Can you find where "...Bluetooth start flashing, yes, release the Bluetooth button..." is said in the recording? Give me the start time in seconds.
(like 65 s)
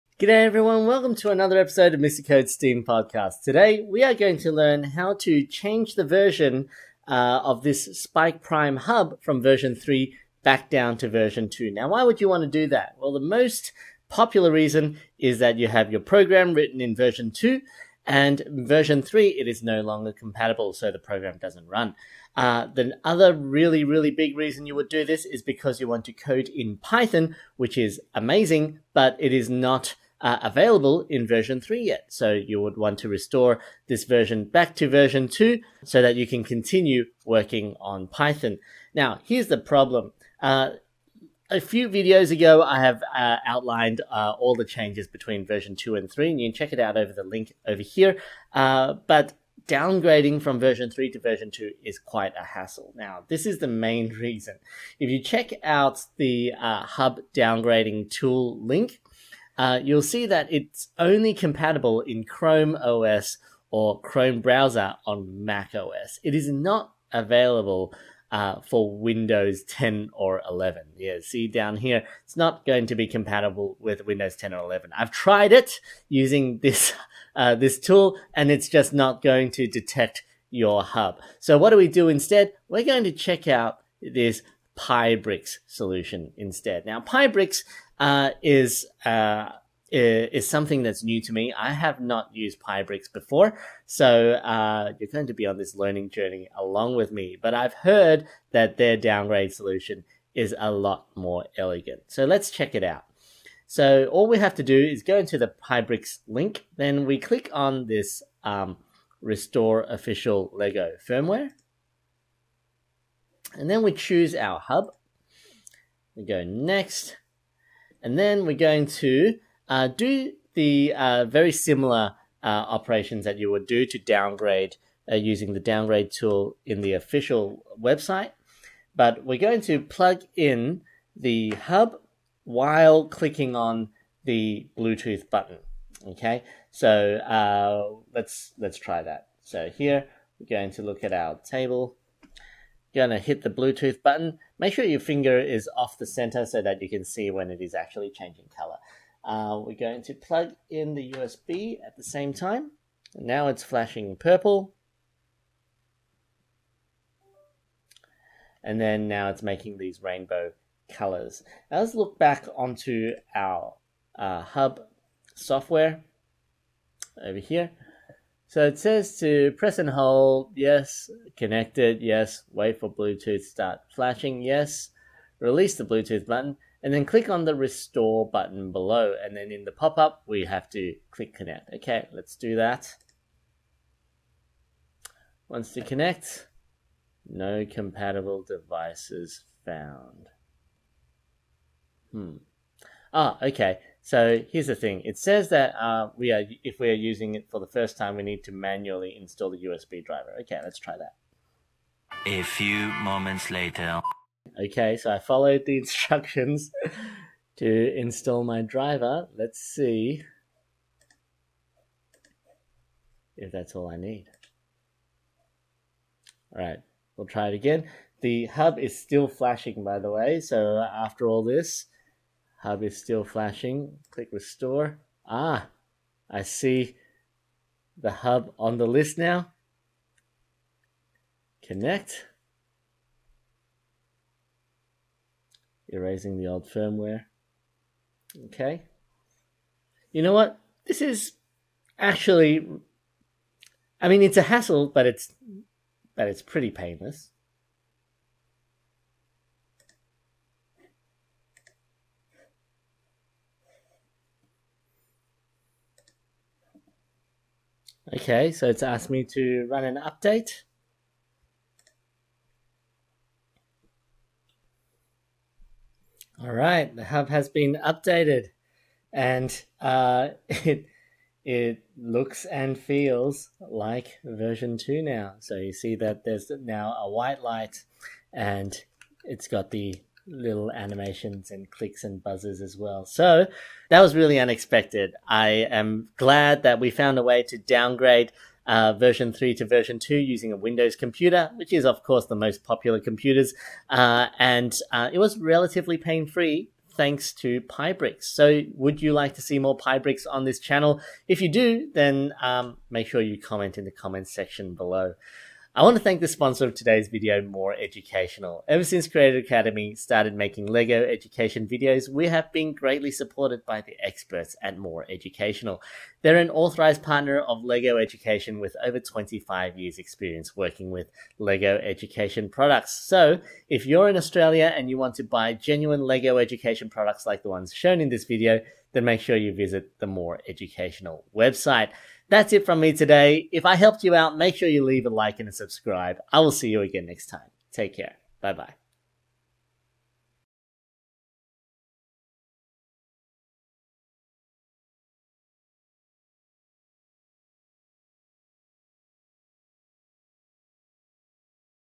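172 s.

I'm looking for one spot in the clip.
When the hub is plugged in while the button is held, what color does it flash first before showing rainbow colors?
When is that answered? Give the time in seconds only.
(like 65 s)
154 s.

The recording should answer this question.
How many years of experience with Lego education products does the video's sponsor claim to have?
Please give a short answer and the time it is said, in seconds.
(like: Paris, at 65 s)
25, at 318 s.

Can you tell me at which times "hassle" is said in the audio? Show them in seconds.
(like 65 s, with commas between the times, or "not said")
52 s, 244 s.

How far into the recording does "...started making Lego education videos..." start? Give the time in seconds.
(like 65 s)
309 s.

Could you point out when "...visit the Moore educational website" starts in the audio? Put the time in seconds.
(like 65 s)
329 s.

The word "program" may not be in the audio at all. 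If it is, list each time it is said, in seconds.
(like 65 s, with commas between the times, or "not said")
16 s, 20 s.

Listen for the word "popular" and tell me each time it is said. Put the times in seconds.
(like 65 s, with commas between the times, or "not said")
14 s, 292 s.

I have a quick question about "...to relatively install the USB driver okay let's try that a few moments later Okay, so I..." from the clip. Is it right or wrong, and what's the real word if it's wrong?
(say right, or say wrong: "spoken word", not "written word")
wrong: "manually", not "relatively".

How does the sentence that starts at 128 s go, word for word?
But we're going to plug in the hub while clicking on the Bluetooth button.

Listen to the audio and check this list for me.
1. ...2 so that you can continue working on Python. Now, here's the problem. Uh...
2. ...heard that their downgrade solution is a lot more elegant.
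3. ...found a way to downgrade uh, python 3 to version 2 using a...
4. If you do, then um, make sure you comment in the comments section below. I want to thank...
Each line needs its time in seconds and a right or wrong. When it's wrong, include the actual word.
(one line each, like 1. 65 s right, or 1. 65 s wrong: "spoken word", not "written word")
1. 35 s right
2. 97 s right
3. 286 s wrong: "version", not "python"
4. 301 s right.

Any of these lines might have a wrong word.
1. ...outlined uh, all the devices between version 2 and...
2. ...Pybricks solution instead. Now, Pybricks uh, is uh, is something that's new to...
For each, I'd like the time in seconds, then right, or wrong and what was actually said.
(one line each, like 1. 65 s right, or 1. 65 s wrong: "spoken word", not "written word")
1. 43 s wrong: "changes", not "devices"
2. 84 s right.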